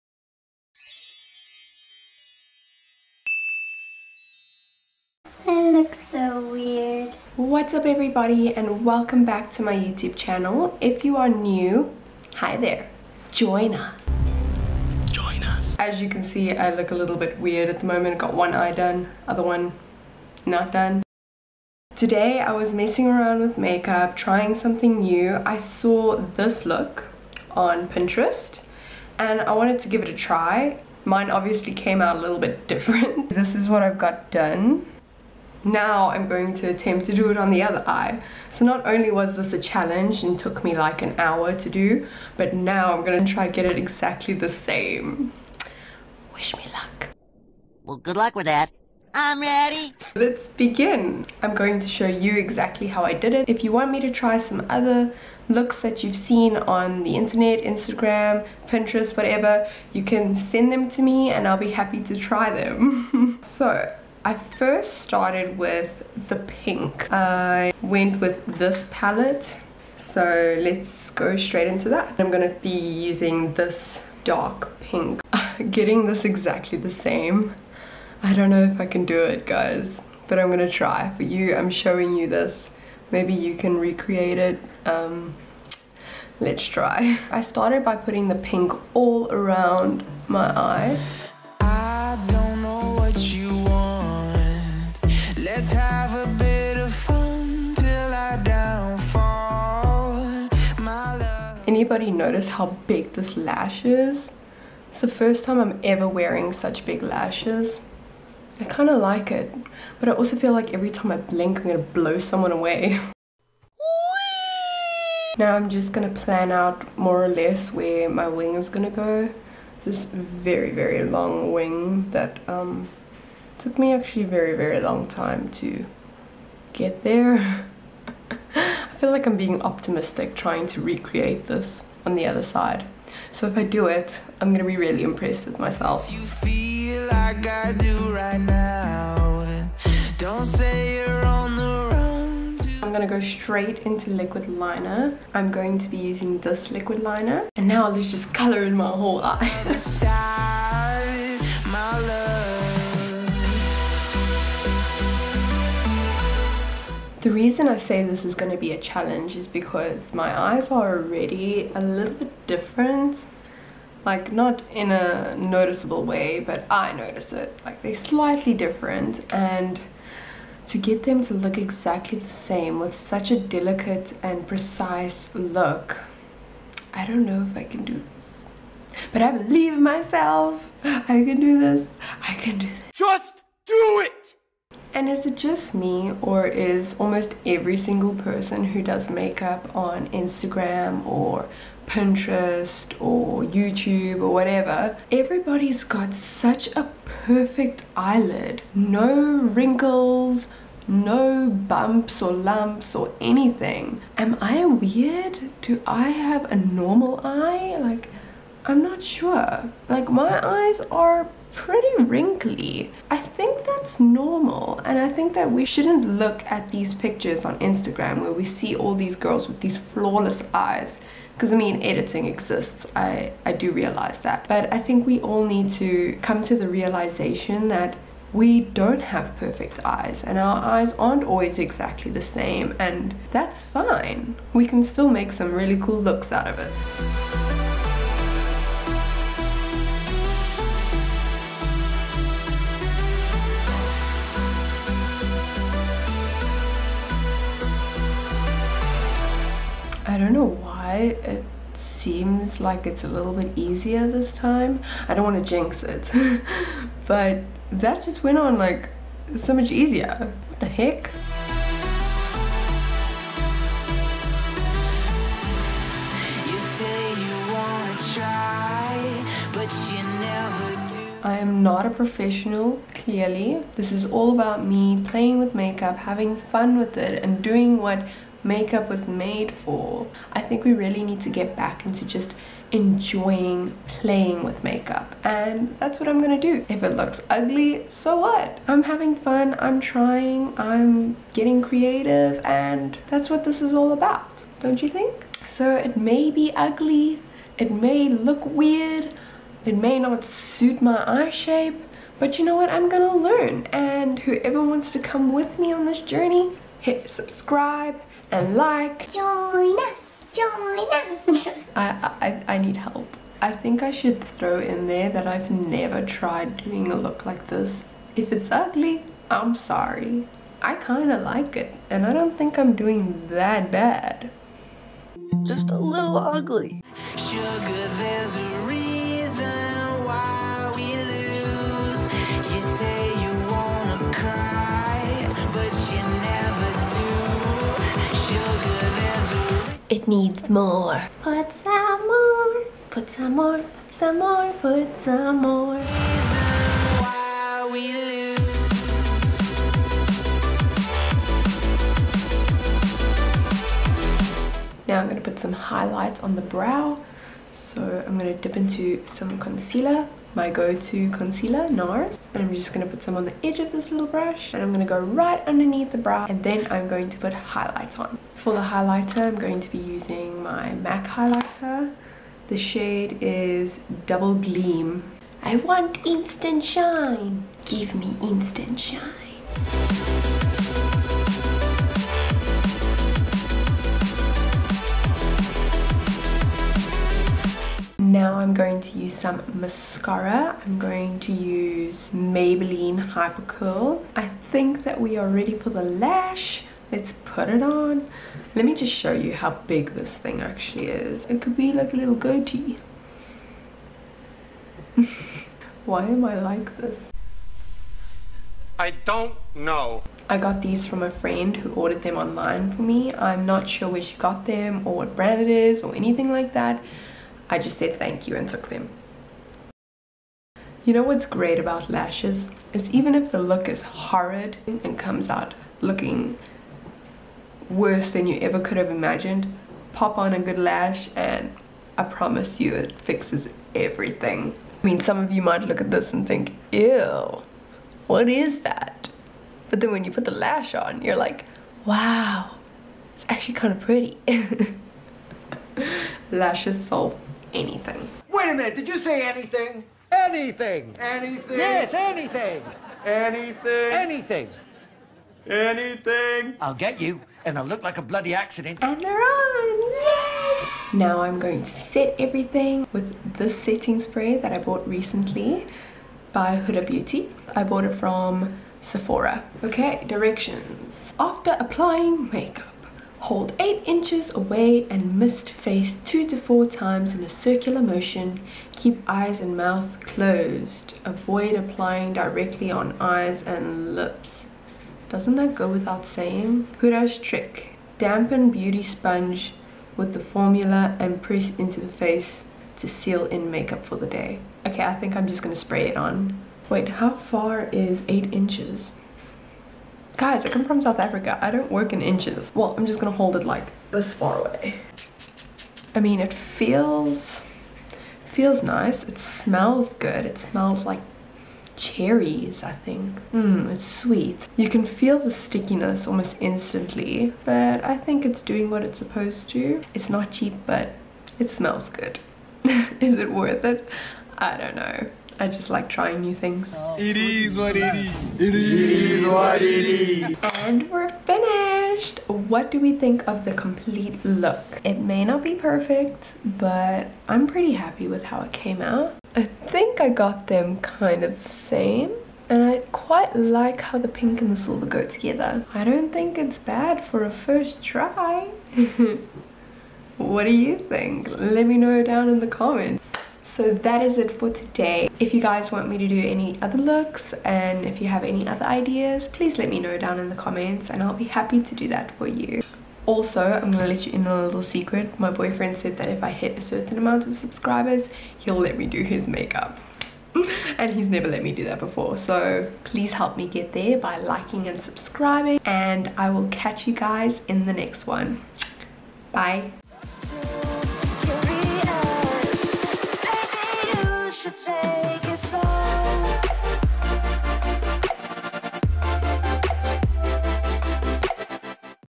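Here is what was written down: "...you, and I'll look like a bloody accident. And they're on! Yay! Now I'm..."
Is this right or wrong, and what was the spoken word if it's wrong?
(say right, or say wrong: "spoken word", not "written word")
right.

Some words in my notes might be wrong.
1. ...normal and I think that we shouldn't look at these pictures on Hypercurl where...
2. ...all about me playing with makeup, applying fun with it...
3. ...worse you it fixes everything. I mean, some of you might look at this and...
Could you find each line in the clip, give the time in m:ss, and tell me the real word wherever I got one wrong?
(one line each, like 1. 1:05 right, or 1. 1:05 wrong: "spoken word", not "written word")
1. 3:33 wrong: "Instagram", not "Hypercurl"
2. 4:34 wrong: "having", not "applying"
3. 7:12 wrong: "promise", not "worse".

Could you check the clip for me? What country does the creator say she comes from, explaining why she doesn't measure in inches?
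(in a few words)
South Africa.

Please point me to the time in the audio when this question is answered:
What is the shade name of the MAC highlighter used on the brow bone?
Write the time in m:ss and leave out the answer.
6:14.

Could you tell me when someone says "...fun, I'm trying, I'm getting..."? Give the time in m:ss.
4:49.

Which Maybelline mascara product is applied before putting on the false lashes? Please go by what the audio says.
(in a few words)
Hypercurl.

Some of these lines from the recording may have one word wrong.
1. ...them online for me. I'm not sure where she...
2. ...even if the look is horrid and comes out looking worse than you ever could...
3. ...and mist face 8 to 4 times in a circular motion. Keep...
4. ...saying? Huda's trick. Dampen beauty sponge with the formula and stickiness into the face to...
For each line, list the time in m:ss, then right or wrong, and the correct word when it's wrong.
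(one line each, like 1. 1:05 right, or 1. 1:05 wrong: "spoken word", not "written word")
1. 6:52 right
2. 7:02 right
3. 7:54 wrong: "2", not "8"
4. 8:06 wrong: "press", not "stickiness".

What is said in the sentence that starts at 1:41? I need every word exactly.
anybody notice how big this lash is?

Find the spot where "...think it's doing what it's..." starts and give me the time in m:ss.
8:37.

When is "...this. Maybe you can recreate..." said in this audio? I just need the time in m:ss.
1:22.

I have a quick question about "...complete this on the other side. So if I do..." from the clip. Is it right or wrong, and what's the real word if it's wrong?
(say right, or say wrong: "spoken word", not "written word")
wrong: "recreate", not "complete".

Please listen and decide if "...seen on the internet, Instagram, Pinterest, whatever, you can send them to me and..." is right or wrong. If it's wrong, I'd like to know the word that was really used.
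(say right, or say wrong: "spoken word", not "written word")
right.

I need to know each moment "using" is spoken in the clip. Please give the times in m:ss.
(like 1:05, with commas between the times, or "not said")
1:12, 2:25, 6:09.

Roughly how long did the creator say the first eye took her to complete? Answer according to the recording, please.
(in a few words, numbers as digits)
an hour.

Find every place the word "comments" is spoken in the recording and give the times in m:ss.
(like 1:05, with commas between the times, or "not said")
9:12, 9:20.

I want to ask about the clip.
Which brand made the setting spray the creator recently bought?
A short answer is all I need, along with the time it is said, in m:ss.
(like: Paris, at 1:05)
Huda Beauty, at 7:46.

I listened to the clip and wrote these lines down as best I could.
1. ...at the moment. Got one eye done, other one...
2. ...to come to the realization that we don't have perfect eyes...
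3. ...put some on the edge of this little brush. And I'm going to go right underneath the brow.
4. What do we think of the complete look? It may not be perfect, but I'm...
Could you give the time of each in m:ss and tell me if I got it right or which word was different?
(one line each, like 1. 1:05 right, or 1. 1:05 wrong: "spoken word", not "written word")
1. 0:17 right
2. 3:45 right
3. 6:02 right
4. 8:52 right.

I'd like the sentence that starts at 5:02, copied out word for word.
I'm gonna learn and whoever wants to come with me on this journey, hit subscribe, and like.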